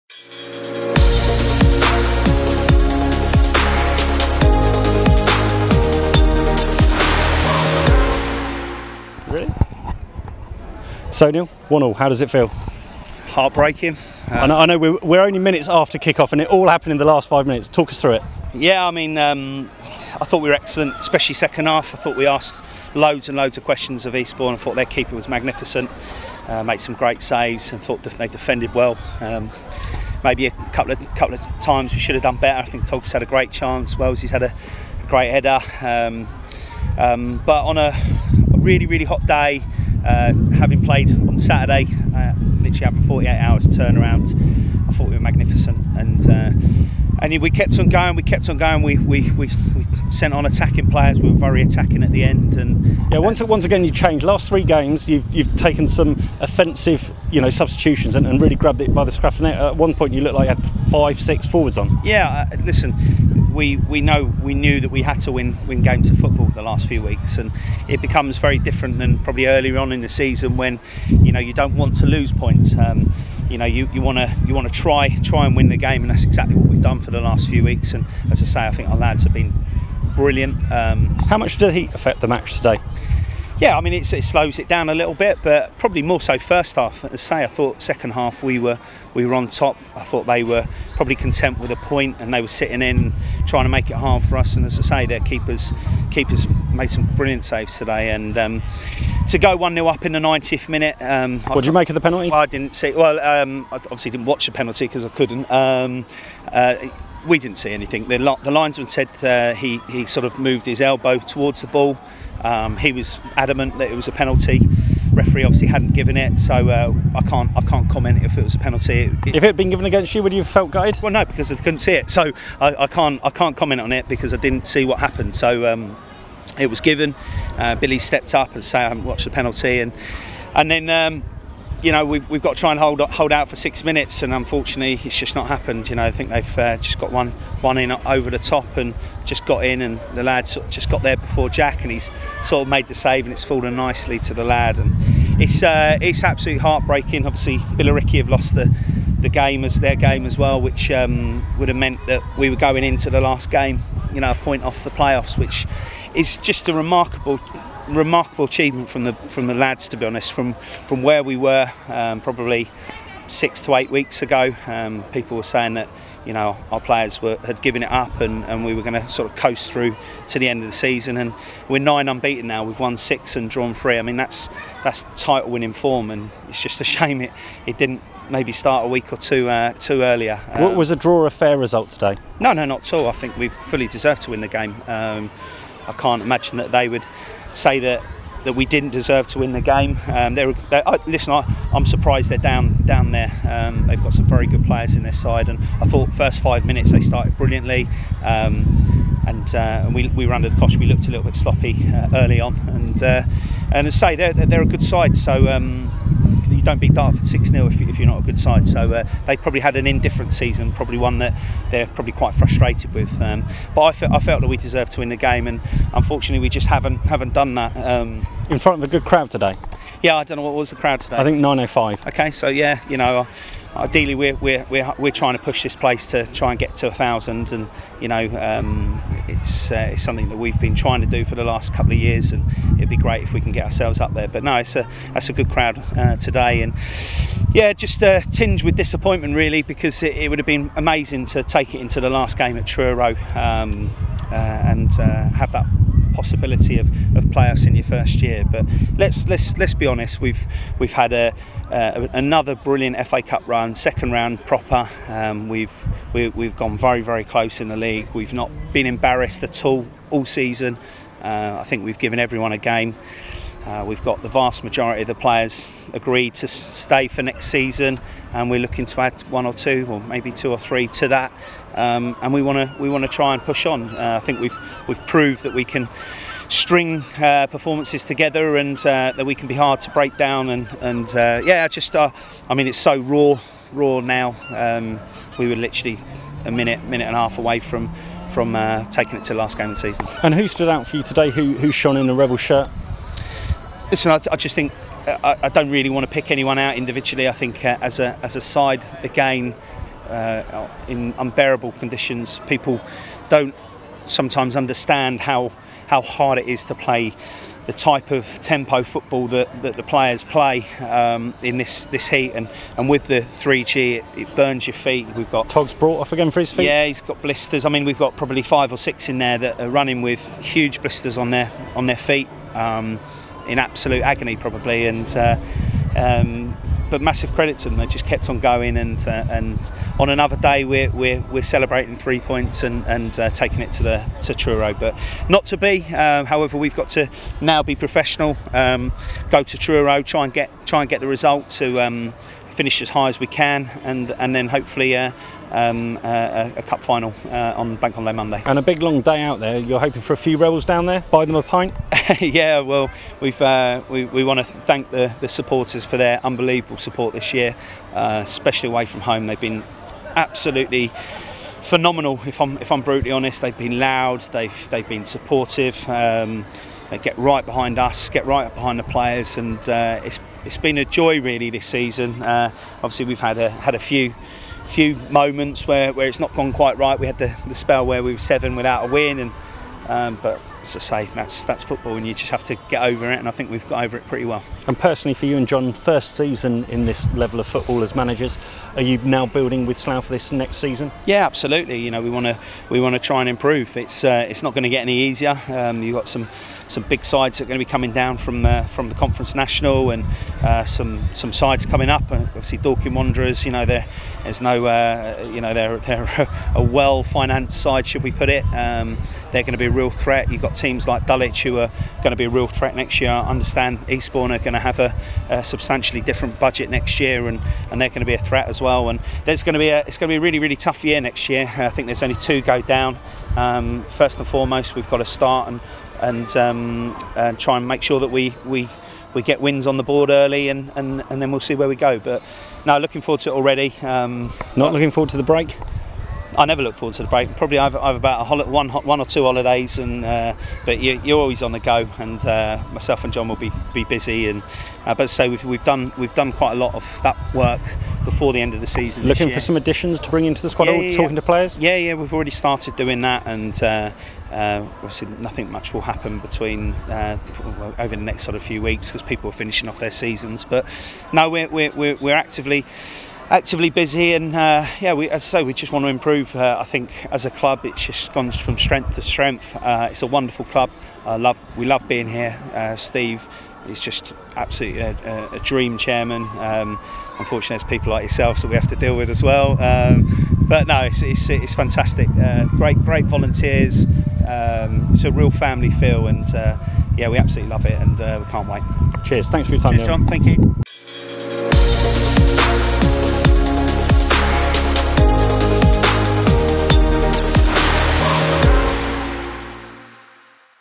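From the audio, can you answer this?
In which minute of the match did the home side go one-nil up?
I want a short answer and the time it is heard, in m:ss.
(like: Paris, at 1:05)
90th, at 1:40.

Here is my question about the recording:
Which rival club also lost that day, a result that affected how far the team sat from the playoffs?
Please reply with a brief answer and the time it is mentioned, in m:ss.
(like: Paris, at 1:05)
Billericay, at 2:27.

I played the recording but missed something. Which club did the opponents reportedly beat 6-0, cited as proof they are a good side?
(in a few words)
Dartford.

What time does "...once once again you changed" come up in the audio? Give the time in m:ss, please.
0:53.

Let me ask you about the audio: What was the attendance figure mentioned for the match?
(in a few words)
905.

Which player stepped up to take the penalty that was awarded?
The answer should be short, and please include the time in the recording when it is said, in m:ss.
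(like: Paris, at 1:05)
Billy, at 2:07.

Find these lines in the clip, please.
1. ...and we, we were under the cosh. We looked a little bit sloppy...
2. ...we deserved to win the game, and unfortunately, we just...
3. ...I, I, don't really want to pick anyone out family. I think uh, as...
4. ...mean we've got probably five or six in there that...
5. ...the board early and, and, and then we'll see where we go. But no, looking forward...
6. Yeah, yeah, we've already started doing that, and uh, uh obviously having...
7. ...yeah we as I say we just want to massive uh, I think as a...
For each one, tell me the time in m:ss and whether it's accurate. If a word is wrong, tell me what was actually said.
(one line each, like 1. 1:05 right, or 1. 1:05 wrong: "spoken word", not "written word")
1. 3:19 right
2. 3:34 right
3. 4:55 wrong: "individually", not "family"
4. 5:17 right
5. 7:09 right
6. 7:31 wrong: "nothing", not "having"
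7. 7:44 wrong: "improve", not "massive".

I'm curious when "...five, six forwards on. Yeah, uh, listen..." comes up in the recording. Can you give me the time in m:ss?
1:00.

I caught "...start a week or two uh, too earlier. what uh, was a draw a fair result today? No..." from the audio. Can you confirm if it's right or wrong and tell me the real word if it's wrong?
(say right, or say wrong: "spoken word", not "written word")
right.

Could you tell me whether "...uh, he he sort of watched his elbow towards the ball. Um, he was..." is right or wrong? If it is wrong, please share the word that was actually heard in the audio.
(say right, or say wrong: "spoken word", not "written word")
wrong: "moved", not "watched".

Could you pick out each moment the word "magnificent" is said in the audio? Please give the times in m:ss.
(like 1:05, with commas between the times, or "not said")
0:25, 0:45.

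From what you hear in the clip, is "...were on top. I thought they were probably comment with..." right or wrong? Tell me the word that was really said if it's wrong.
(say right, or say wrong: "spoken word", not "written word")
wrong: "content", not "comment".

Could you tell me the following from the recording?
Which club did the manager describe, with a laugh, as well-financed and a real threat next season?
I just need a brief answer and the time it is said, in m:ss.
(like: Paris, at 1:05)
Dorking Wanderers, at 6:42.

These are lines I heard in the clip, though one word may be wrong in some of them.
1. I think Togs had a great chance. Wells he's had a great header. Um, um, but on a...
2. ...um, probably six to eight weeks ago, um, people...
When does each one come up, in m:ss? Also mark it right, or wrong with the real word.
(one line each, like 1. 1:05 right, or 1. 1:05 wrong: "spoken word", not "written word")
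1. 0:32 right
2. 2:41 right.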